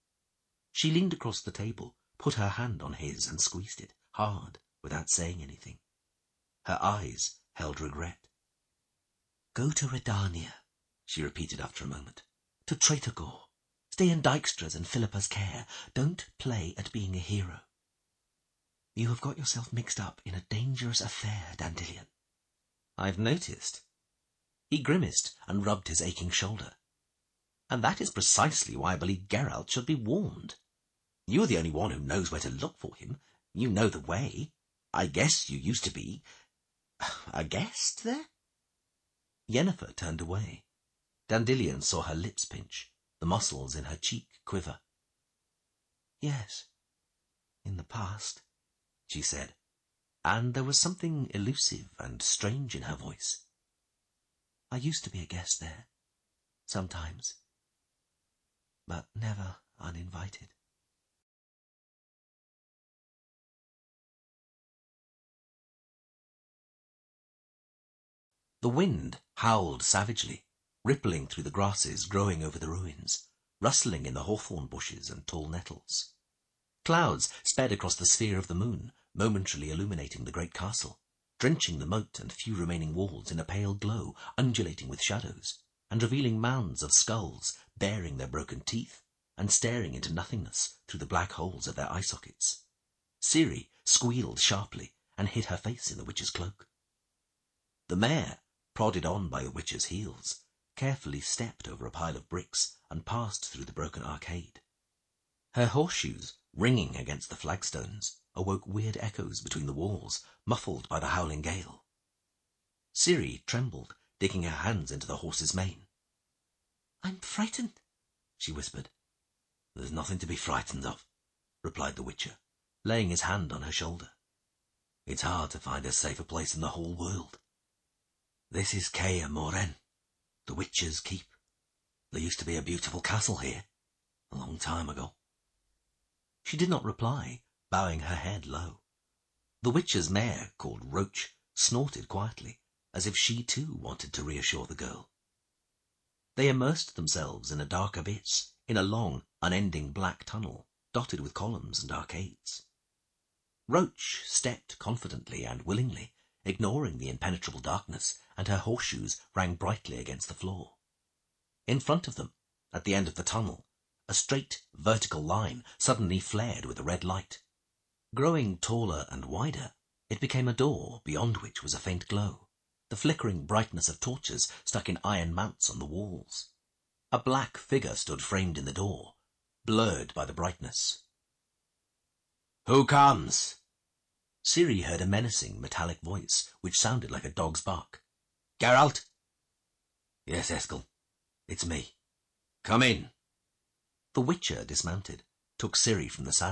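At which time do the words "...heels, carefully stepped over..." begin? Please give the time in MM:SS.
01:39.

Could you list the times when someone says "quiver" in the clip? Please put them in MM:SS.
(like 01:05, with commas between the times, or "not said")
00:44.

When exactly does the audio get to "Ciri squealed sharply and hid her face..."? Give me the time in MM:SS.
01:33.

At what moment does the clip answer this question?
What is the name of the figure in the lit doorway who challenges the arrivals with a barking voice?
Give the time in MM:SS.
03:10.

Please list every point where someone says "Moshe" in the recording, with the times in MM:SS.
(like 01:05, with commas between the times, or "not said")
not said.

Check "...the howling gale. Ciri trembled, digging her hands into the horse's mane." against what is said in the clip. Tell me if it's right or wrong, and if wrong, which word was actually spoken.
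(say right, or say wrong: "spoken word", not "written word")
right.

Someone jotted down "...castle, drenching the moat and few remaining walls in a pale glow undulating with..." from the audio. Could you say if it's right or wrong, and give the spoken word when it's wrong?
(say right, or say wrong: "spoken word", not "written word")
right.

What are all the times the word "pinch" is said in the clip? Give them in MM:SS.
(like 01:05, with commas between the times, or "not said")
00:42.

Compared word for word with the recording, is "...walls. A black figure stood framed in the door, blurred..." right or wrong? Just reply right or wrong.
right.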